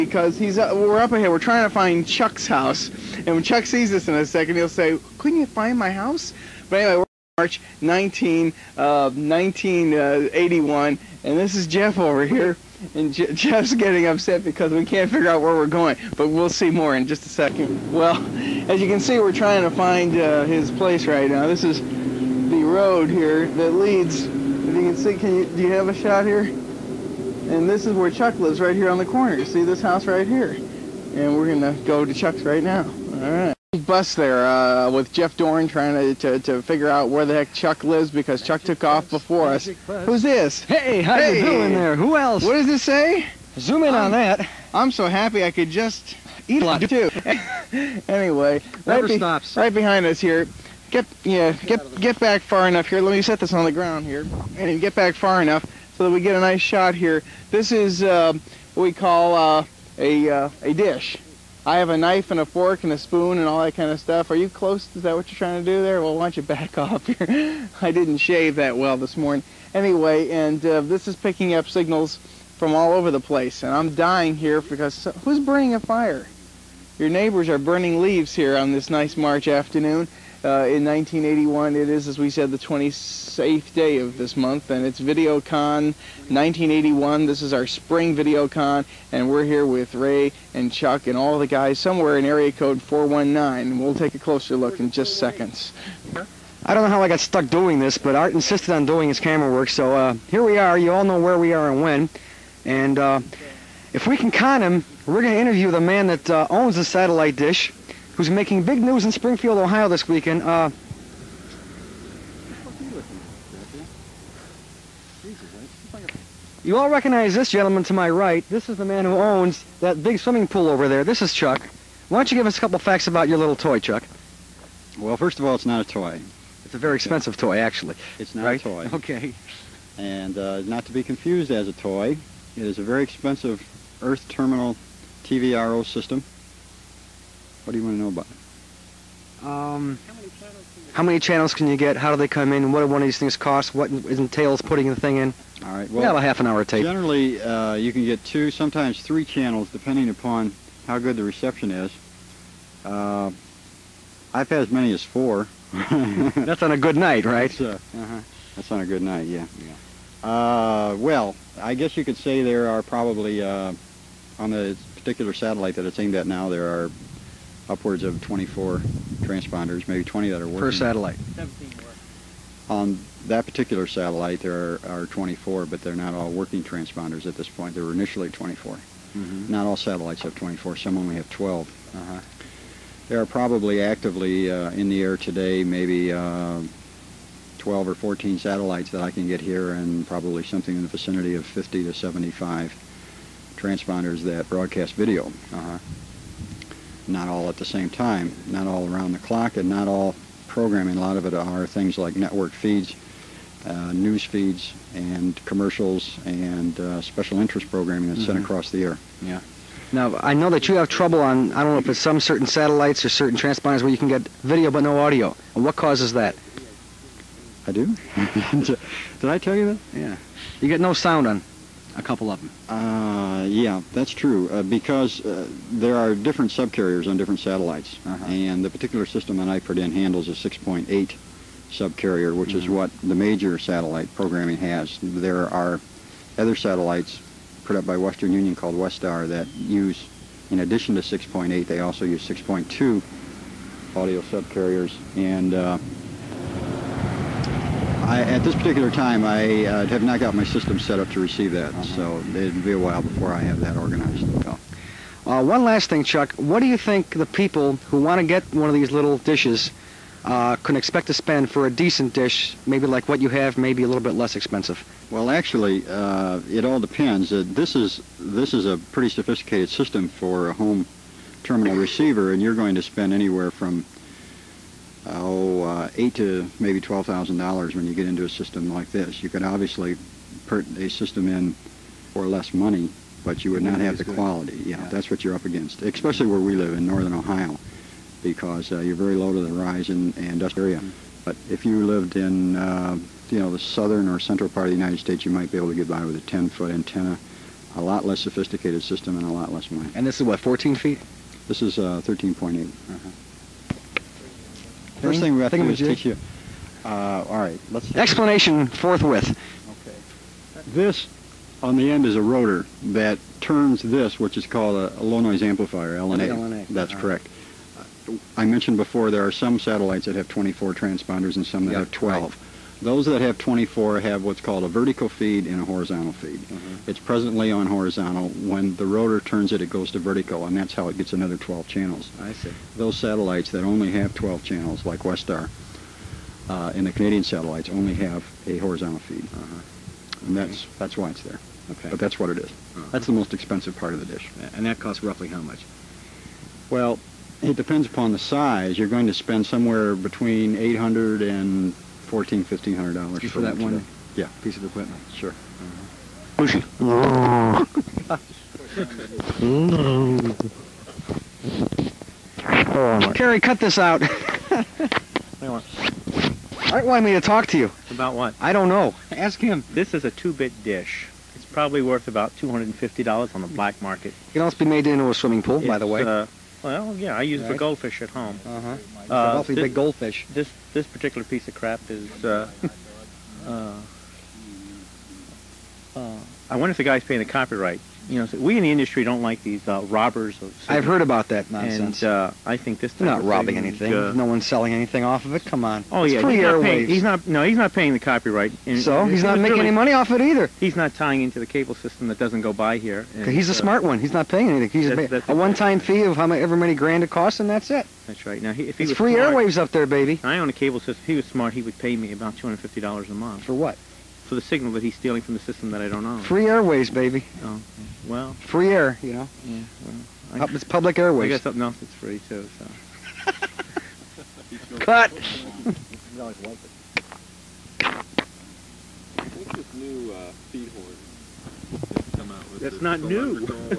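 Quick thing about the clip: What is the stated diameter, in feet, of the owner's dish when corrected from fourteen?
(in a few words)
13.8.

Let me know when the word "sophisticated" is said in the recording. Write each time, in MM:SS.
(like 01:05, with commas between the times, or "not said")
04:29, 04:58.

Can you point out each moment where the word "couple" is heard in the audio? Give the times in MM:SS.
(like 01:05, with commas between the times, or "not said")
02:02, 03:42.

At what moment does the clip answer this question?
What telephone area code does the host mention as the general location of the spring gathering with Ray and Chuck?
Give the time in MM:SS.
01:32.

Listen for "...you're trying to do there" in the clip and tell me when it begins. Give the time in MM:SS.
01:05.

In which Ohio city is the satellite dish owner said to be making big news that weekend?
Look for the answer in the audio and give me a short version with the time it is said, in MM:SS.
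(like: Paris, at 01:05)
Springfield, at 01:49.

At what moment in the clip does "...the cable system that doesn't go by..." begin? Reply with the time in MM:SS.
06:41.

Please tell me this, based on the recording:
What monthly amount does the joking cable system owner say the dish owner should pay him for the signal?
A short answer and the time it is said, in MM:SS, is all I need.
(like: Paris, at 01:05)
$250, at 06:52.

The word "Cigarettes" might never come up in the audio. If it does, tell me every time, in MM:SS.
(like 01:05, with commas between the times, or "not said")
06:30.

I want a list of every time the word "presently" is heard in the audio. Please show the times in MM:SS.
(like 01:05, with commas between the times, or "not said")
05:26.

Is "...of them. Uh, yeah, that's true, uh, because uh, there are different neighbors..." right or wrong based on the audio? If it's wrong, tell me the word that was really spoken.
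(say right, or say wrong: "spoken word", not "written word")
wrong: "subcarriers", not "neighbors".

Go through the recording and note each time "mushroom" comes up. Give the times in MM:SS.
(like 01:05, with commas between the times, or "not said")
not said.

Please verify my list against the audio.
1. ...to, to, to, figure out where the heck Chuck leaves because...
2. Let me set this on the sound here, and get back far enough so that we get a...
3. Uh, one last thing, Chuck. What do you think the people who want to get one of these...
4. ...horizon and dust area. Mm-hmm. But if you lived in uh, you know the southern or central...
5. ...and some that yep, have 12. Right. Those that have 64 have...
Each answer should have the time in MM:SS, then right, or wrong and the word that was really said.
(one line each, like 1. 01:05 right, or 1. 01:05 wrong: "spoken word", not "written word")
1. 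00:35 wrong: "lives", not "leaves"
2. 00:53 wrong: "ground", not "sound"
3. 04:15 right
4. 04:49 right
5. 05:21 wrong: "24", not "64".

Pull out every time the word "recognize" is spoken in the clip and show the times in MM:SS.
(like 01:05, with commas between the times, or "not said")
01:56.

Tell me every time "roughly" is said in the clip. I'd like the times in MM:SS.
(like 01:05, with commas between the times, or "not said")
05:45.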